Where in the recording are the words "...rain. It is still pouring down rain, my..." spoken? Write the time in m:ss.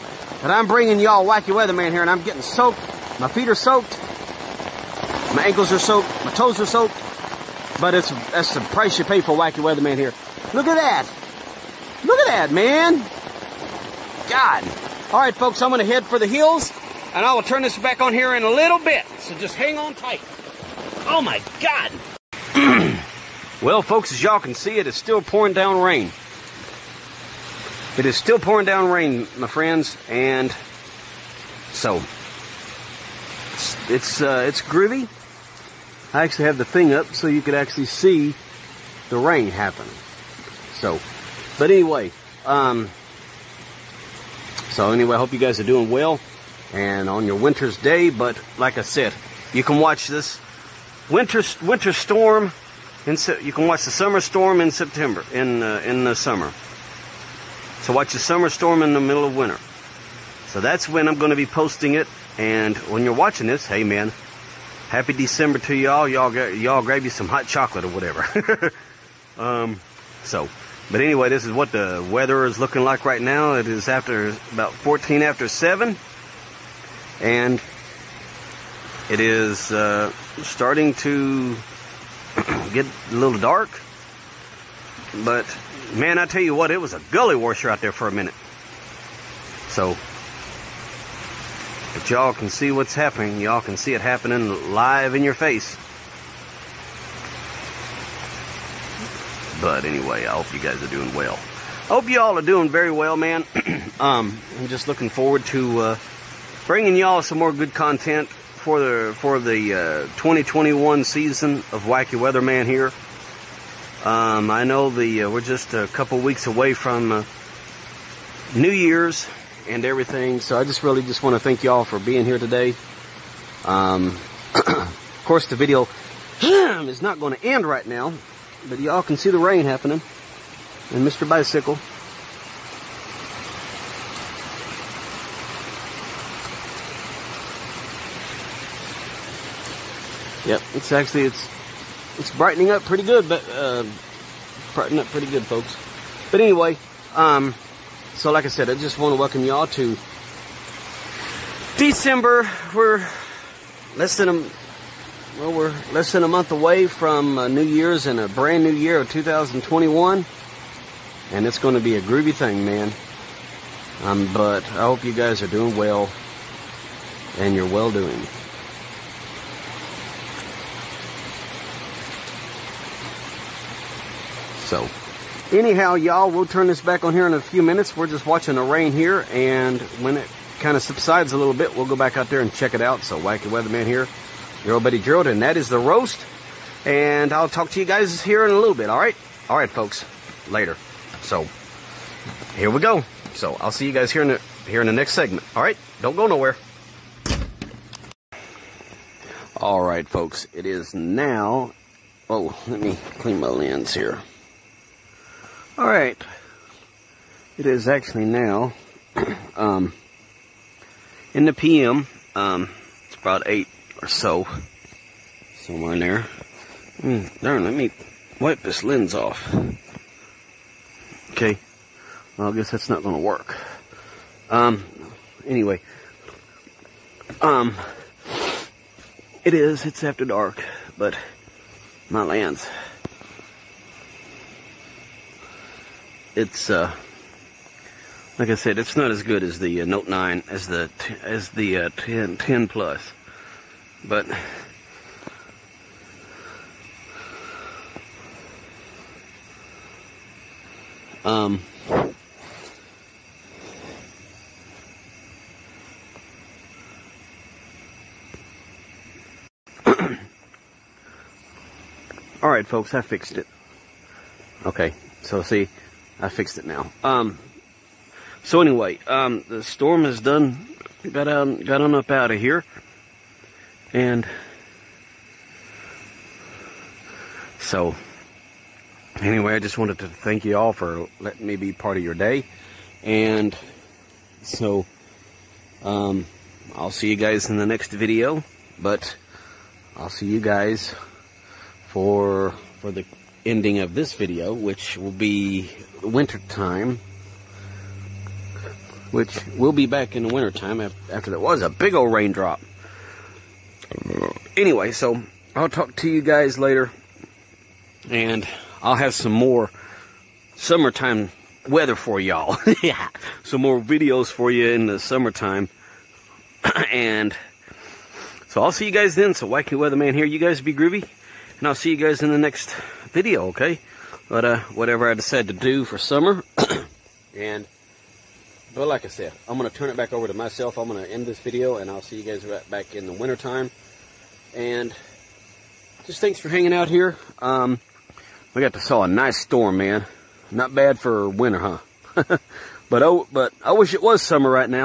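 0:25.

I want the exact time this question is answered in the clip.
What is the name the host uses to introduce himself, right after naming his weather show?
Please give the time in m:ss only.
3:04.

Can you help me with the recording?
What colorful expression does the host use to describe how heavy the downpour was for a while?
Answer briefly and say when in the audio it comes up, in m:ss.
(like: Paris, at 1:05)
gully washer, at 1:27.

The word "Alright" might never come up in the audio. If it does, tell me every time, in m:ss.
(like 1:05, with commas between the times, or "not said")
3:25, 4:22.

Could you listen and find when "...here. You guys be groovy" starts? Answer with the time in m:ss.
5:20.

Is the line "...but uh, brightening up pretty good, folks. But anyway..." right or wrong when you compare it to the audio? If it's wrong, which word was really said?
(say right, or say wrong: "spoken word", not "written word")
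right.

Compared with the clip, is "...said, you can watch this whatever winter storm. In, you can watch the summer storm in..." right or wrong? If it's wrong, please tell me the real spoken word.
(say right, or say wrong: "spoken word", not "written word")
wrong: "winter", not "whatever".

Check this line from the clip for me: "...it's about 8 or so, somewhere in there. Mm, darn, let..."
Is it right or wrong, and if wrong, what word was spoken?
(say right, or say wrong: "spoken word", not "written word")
right.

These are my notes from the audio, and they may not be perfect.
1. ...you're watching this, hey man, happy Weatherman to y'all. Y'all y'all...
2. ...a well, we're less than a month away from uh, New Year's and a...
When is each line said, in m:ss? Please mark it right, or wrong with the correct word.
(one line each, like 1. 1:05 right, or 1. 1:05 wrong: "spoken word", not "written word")
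1. 1:03 wrong: "December", not "Weatherman"
2. 2:34 right.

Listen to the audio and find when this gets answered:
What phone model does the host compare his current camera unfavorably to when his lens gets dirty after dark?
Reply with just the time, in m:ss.
3:59.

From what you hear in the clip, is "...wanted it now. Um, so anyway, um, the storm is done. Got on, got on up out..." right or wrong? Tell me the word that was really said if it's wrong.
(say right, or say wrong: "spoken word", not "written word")
wrong: "fixed", not "wanted".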